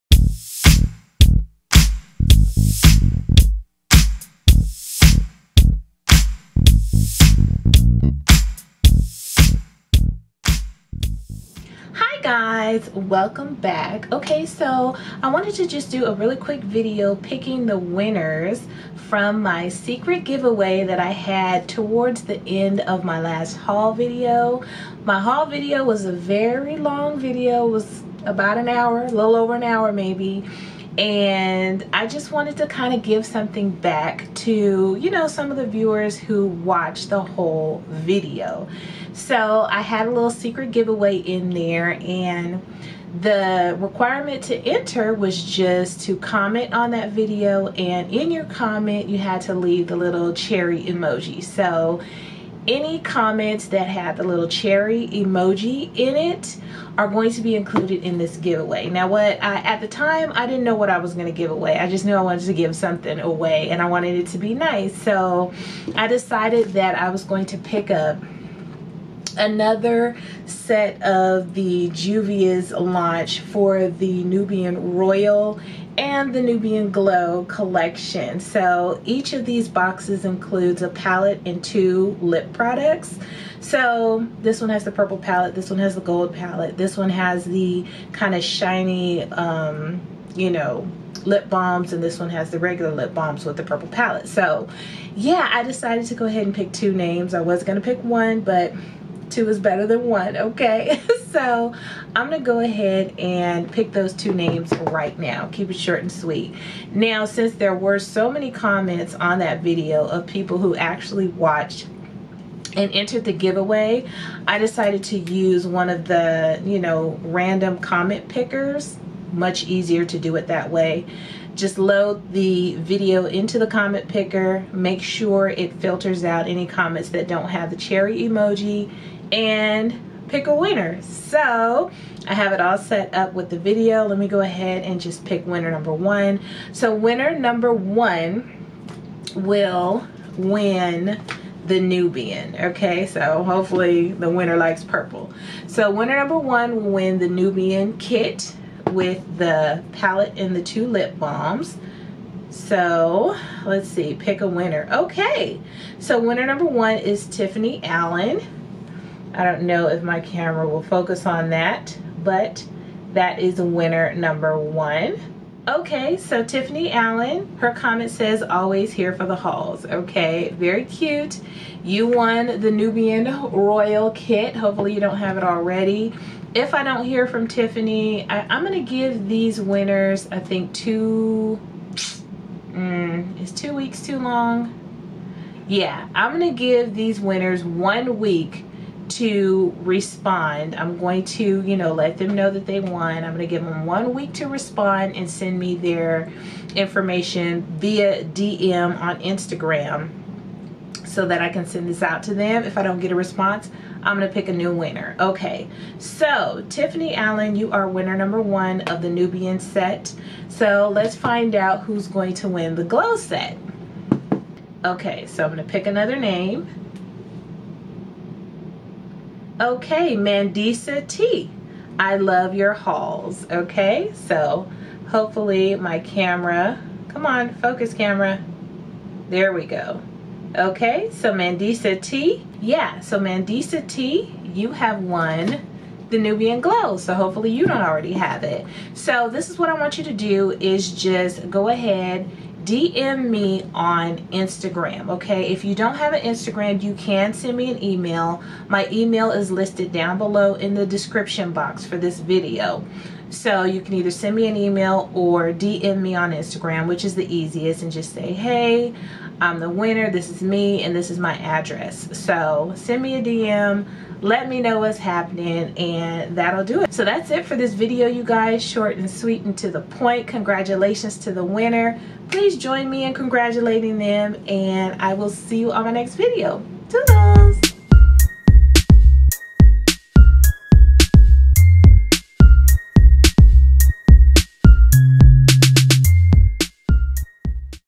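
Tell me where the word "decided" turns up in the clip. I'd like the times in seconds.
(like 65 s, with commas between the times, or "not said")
66 s, 95 s, 114 s.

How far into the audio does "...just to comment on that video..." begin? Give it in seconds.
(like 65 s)
45 s.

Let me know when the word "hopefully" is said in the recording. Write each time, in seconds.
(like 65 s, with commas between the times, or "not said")
143 s, 174 s, 225 s, 237 s.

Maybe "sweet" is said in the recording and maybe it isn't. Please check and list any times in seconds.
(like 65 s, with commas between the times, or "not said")
106 s, 269 s.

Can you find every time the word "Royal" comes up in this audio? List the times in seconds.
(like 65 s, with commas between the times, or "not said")
74 s, 173 s.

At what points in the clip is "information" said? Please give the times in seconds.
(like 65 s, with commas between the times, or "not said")
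196 s.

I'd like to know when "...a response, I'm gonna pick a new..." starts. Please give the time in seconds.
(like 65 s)
203 s.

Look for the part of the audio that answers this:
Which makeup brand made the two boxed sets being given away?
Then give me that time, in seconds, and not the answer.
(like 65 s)
71 s.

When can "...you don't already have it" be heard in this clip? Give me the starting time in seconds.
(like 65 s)
237 s.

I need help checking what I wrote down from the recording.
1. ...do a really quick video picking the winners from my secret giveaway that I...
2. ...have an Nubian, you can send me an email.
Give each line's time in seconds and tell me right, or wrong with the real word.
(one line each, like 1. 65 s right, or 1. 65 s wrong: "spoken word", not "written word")
1. 15 s right
2. 245 s wrong: "Instagram", not "Nubian".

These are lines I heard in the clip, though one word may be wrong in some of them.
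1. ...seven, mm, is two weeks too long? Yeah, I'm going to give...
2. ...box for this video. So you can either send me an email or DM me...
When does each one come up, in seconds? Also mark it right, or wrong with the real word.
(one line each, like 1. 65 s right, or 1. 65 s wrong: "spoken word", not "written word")
1. 180 s wrong: "two", not "seven"
2. 251 s right.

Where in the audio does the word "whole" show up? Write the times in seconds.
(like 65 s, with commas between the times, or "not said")
37 s.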